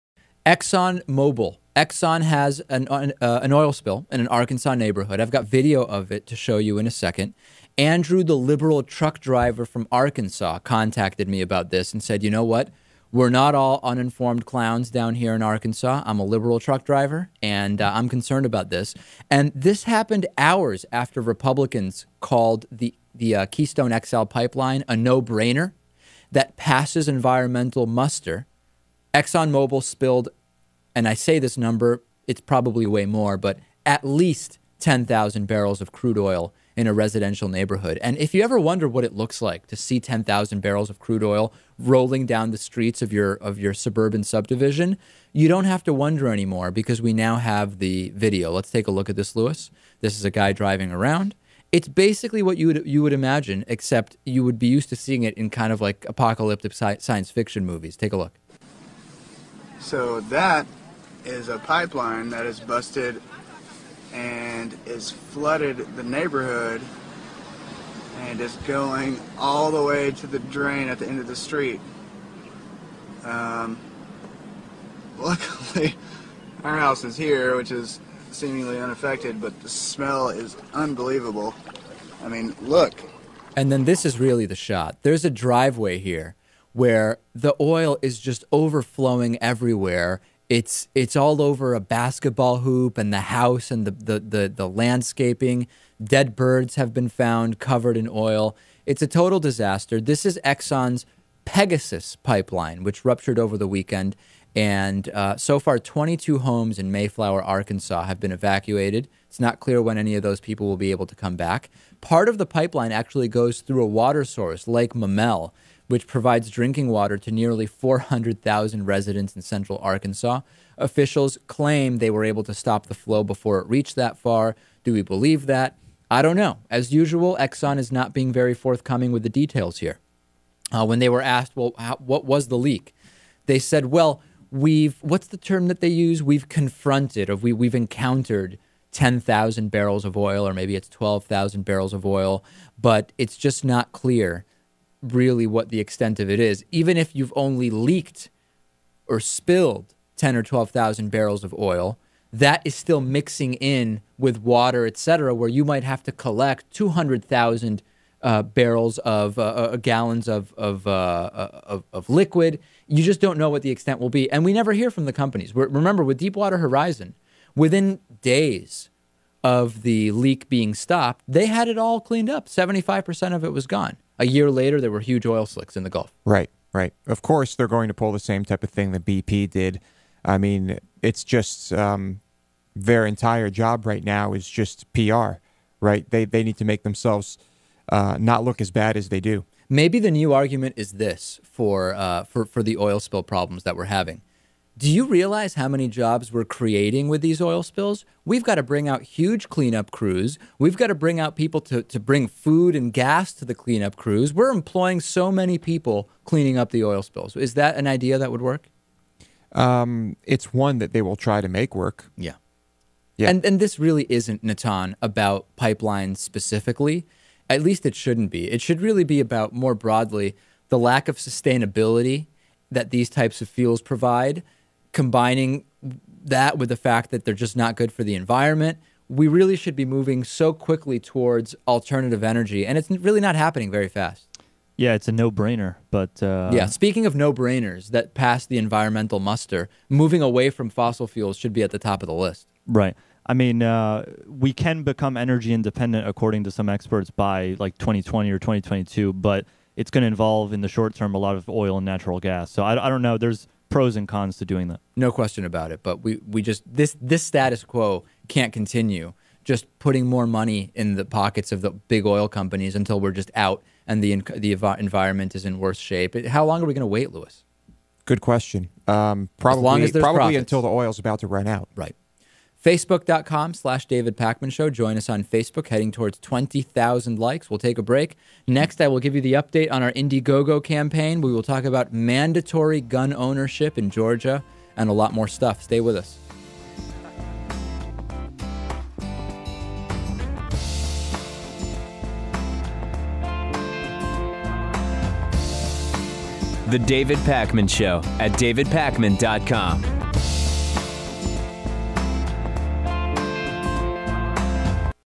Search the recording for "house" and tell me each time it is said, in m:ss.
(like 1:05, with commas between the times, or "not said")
1:16, 1:33.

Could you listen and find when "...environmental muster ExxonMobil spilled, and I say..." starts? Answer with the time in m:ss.
0:27.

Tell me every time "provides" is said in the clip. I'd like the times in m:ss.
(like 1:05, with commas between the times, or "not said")
1:56, 3:43.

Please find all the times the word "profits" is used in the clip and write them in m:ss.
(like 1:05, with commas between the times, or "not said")
4:30.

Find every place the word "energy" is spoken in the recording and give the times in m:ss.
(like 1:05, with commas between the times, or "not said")
3:52, 4:05.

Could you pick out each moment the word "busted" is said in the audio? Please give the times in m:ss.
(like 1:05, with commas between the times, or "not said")
1:02.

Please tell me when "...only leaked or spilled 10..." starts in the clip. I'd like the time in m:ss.
2:27.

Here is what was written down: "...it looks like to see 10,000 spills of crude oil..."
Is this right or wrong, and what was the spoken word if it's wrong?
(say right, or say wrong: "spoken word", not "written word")
wrong: "barrels", not "spills".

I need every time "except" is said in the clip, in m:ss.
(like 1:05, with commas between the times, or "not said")
0:53.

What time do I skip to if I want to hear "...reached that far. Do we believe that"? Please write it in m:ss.
2:03.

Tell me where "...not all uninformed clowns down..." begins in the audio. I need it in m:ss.
0:13.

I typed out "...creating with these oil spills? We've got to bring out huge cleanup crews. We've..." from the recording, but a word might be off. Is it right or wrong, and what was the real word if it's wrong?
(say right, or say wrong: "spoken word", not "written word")
right.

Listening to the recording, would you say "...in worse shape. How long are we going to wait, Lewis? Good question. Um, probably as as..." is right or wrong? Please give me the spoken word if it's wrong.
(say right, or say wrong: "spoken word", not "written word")
right.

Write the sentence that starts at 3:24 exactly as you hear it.
We're employing so many people cleaning up the oil spills.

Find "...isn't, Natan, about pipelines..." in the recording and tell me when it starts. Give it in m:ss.
3:34.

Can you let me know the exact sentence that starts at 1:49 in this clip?
It's not clear when any of those people will be able to come back.